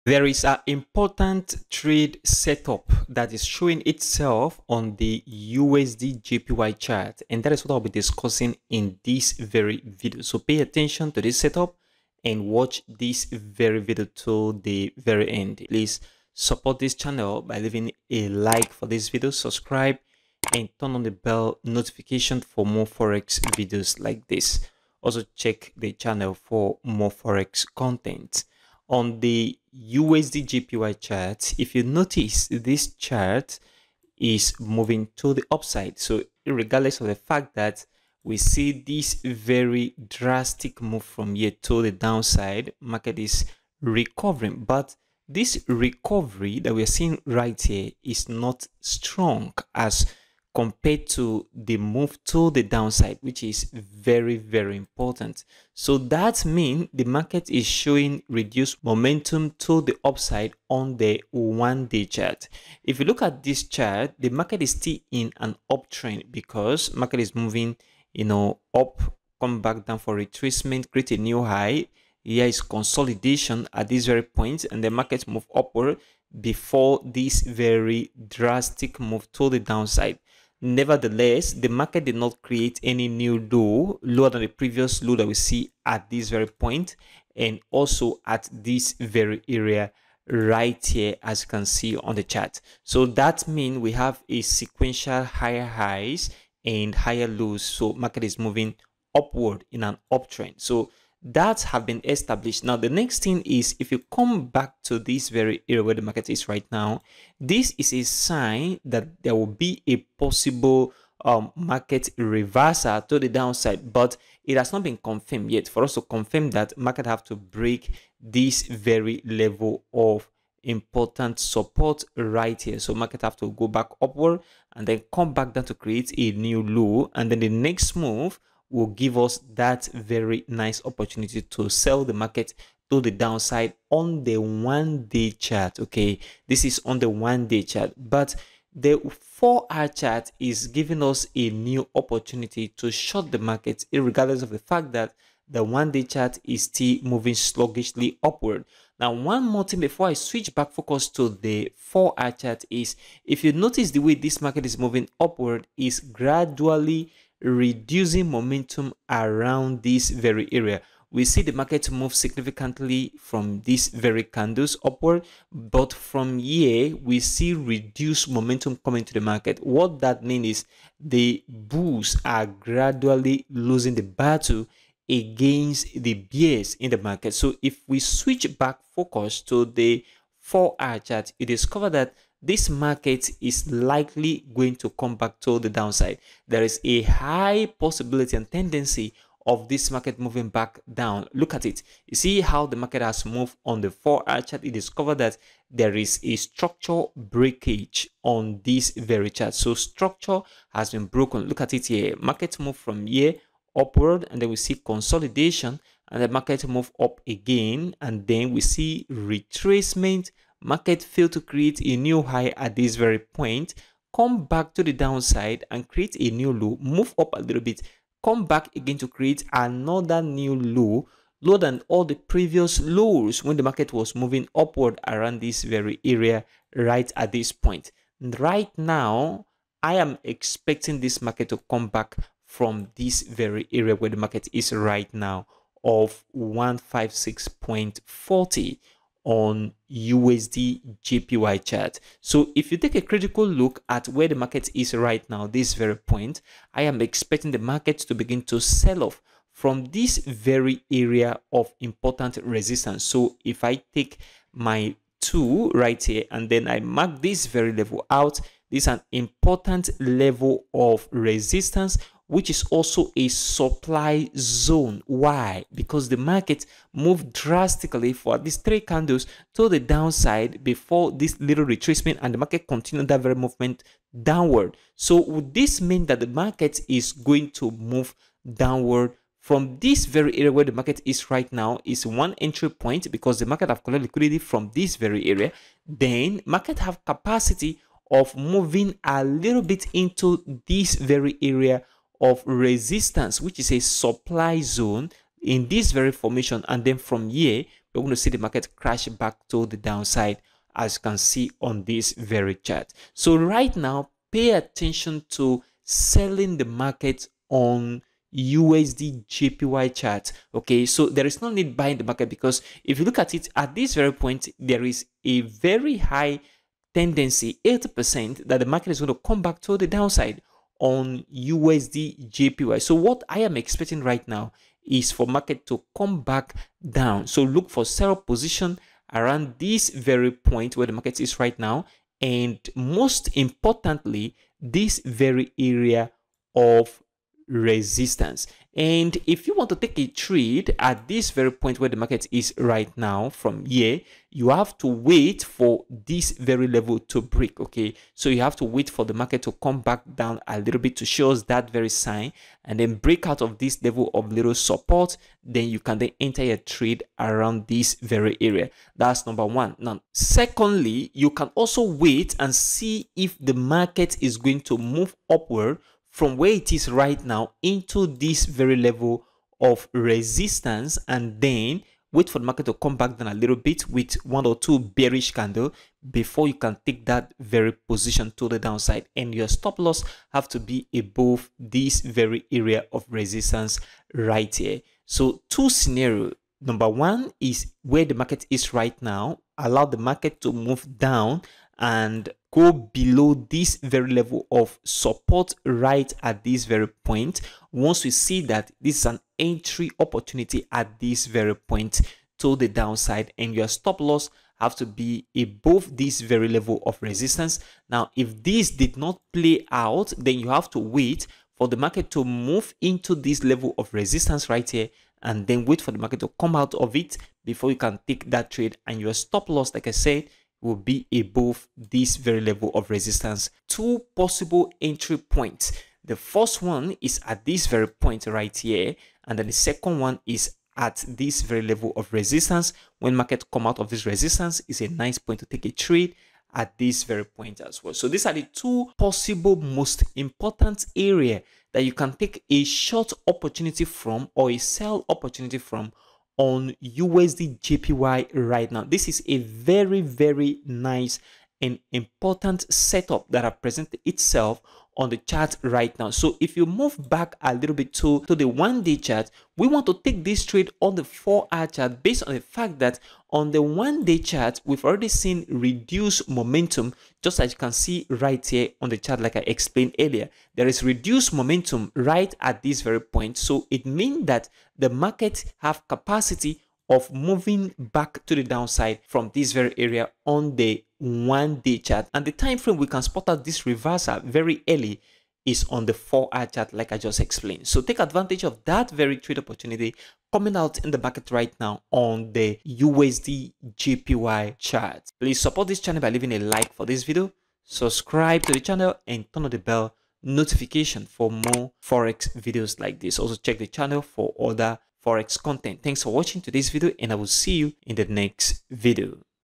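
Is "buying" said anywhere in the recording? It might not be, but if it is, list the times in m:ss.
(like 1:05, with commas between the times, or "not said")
5:11.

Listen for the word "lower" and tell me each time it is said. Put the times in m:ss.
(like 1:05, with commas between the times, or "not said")
1:24, 3:41.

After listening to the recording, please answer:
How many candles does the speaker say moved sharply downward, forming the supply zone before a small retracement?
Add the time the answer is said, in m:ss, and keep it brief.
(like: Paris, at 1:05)
3, at 4:28.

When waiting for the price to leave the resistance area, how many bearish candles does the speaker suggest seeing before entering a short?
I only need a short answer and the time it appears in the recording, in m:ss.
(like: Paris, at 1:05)
One or two, at 6:14.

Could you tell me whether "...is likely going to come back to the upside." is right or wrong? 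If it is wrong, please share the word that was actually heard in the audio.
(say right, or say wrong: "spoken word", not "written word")
wrong: "downside", not "upside".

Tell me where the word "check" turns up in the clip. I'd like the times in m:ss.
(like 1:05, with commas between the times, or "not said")
0:25, 8:23.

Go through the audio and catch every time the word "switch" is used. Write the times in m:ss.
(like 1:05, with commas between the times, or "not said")
2:30, 2:57.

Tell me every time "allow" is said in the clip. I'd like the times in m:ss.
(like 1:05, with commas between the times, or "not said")
6:29.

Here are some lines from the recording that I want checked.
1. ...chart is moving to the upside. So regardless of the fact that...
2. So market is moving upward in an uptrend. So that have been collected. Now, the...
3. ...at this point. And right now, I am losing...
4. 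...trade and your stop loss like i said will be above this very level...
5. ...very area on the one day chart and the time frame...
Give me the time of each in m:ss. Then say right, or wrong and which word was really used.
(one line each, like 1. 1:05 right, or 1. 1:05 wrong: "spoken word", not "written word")
1. 0:32 right
2. 1:37 wrong: "established", not "collected"
3. 3:47 wrong: "expecting", not "losing"
4. 6:58 right
5. 7:59 right.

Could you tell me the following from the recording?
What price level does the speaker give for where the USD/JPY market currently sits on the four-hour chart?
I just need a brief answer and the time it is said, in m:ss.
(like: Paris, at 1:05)
156.40, at 3:56.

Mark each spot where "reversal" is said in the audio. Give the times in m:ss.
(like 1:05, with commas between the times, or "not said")
1:52, 8:03.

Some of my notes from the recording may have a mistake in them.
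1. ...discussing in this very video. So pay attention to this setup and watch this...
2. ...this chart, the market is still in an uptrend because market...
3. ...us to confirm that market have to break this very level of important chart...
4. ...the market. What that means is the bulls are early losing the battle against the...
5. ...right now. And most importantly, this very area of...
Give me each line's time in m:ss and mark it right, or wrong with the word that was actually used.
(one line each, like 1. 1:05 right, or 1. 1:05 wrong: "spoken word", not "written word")
1. 0:07 right
2. 1:03 right
3. 1:55 wrong: "support", not "chart"
4. 2:49 wrong: "gradually", not "early"
5. 5:31 right.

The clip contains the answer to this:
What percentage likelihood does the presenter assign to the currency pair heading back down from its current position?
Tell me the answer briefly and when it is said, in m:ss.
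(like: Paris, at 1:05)
80%, at 5:17.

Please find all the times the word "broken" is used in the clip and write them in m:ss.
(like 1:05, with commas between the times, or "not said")
3:21.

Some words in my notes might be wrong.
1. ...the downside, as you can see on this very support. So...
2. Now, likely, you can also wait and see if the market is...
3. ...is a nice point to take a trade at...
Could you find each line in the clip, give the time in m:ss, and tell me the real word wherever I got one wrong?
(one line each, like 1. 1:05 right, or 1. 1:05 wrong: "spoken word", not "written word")
1. 4:59 wrong: "chart", not "support"
2. 5:59 wrong: "secondly", not "likely"
3. 7:14 right.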